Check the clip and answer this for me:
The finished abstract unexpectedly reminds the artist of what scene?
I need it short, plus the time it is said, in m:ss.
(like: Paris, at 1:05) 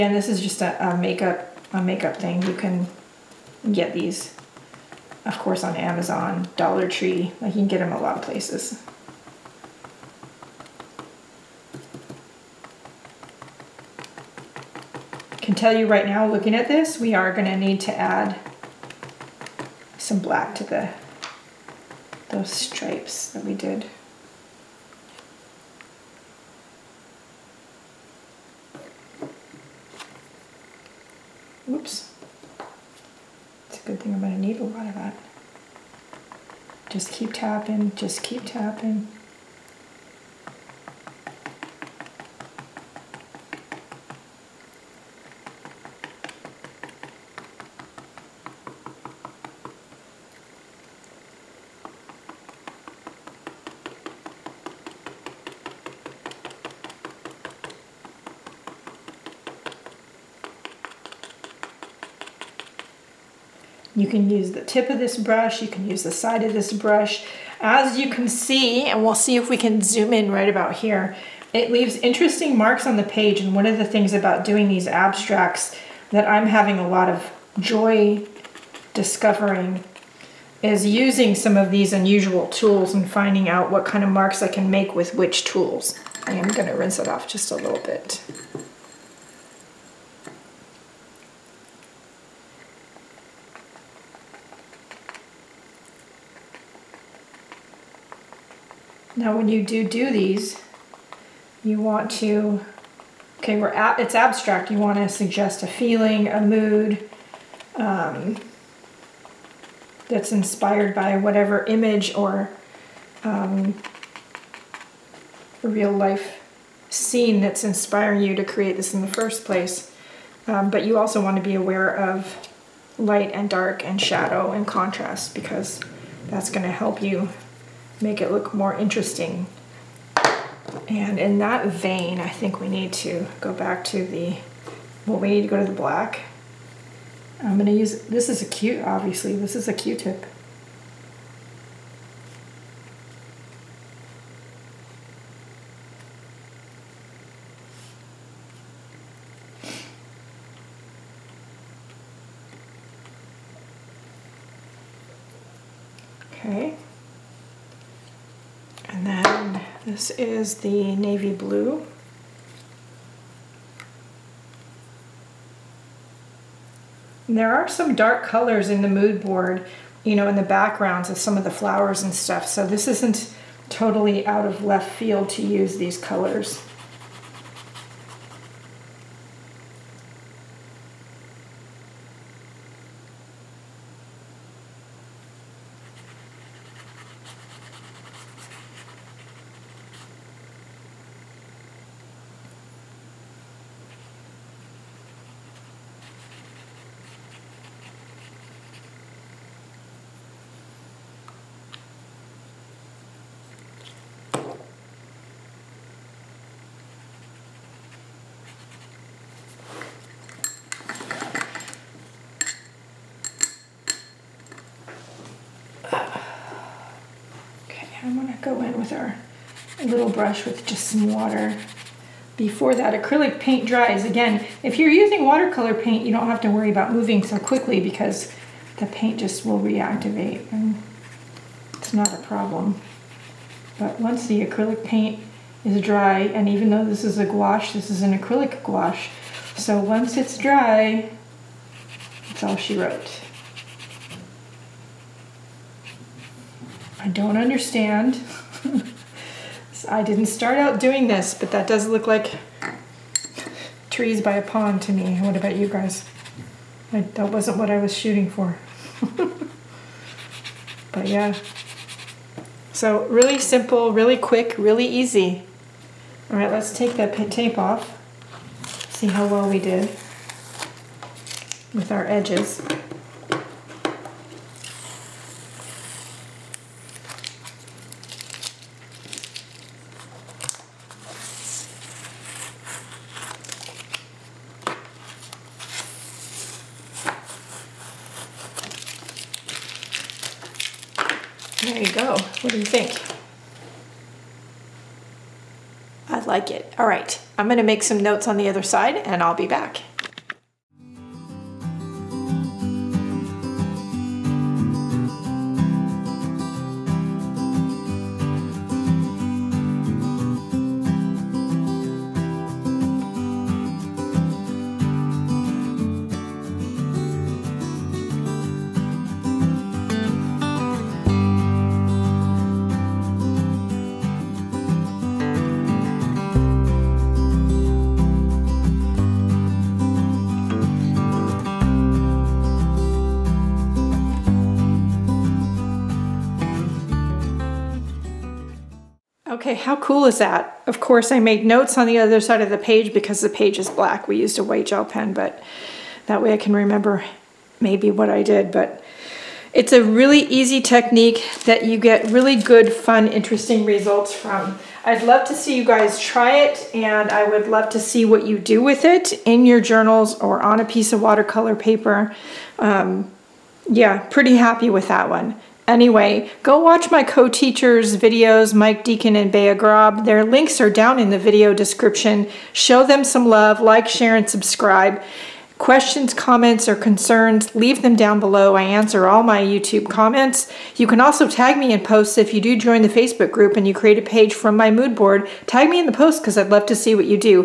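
trees by a pond, at 4:13.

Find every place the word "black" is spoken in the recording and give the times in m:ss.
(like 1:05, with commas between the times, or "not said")
0:20, 2:15, 5:43.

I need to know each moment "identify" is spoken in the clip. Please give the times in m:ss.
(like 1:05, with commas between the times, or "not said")
not said.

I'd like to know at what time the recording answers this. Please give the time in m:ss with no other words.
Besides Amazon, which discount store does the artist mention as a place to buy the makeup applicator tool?
0:06.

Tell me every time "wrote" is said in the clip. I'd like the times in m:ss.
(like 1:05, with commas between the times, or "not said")
4:02.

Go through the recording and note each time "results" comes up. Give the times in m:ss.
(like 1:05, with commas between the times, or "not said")
5:53.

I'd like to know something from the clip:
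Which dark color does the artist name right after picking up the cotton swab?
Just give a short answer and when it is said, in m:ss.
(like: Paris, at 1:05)
navy blue, at 2:40.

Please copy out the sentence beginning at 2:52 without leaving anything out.
So this isn't totally out of left field to use these colors.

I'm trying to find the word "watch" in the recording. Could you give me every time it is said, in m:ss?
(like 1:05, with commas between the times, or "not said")
6:06.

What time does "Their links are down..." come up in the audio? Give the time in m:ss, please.
6:10.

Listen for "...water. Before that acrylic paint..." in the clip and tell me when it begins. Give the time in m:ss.
3:41.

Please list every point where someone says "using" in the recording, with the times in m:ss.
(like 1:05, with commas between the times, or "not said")
1:20, 3:44.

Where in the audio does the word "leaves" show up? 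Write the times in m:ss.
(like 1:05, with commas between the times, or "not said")
1:11, 6:17.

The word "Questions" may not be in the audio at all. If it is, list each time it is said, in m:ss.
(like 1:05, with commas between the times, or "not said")
6:15.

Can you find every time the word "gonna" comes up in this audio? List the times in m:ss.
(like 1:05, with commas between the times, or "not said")
0:17, 0:34, 1:26, 2:17, 4:57.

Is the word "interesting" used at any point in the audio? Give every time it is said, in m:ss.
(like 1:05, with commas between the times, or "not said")
1:11, 2:08, 5:53.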